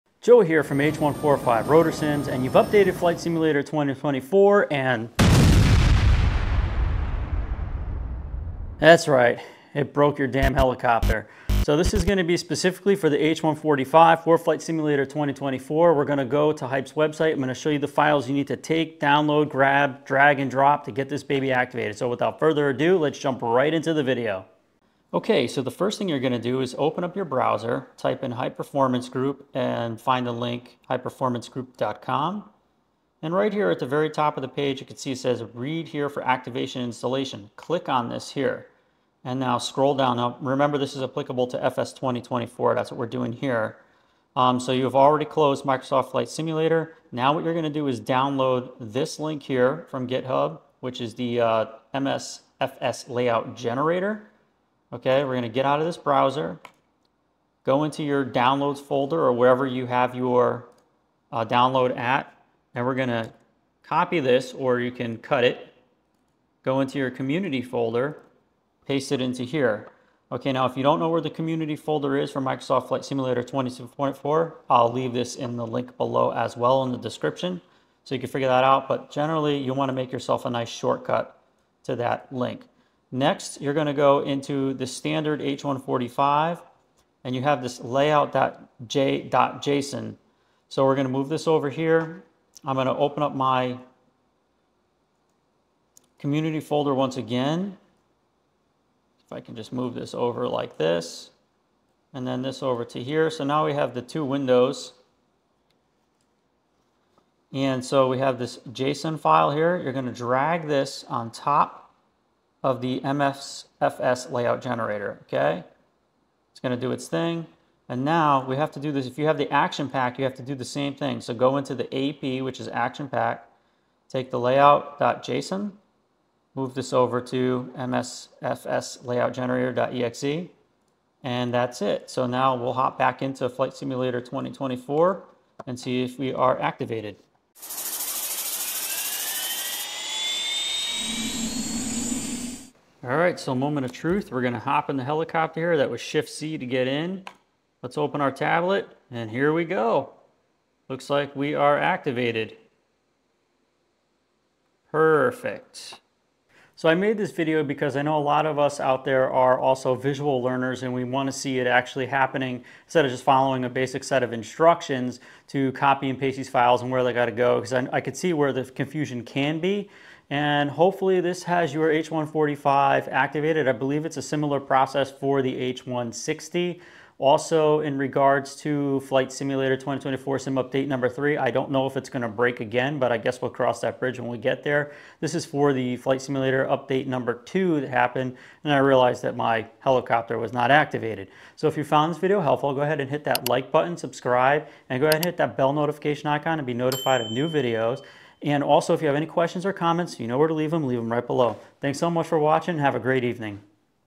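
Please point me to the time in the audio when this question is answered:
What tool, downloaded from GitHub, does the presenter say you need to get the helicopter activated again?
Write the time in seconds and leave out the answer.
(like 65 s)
51 s.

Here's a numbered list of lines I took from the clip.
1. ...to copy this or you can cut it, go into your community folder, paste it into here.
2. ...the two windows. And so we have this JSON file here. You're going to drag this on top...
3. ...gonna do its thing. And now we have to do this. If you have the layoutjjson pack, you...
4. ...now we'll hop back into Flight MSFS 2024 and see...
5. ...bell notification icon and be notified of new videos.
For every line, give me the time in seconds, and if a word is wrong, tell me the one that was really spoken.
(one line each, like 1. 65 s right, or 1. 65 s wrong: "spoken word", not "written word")
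1. 63 s right
2. 103 s right
3. 116 s wrong: "action", not "layoutjjson"
4. 132 s wrong: "Simulator", not "MSFS"
5. 195 s right.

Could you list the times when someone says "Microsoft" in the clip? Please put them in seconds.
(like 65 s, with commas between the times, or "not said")
45 s, 72 s.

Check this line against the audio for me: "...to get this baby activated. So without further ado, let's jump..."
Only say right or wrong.
right.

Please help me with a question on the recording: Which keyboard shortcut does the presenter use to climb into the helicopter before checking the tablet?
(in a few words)
Shift C.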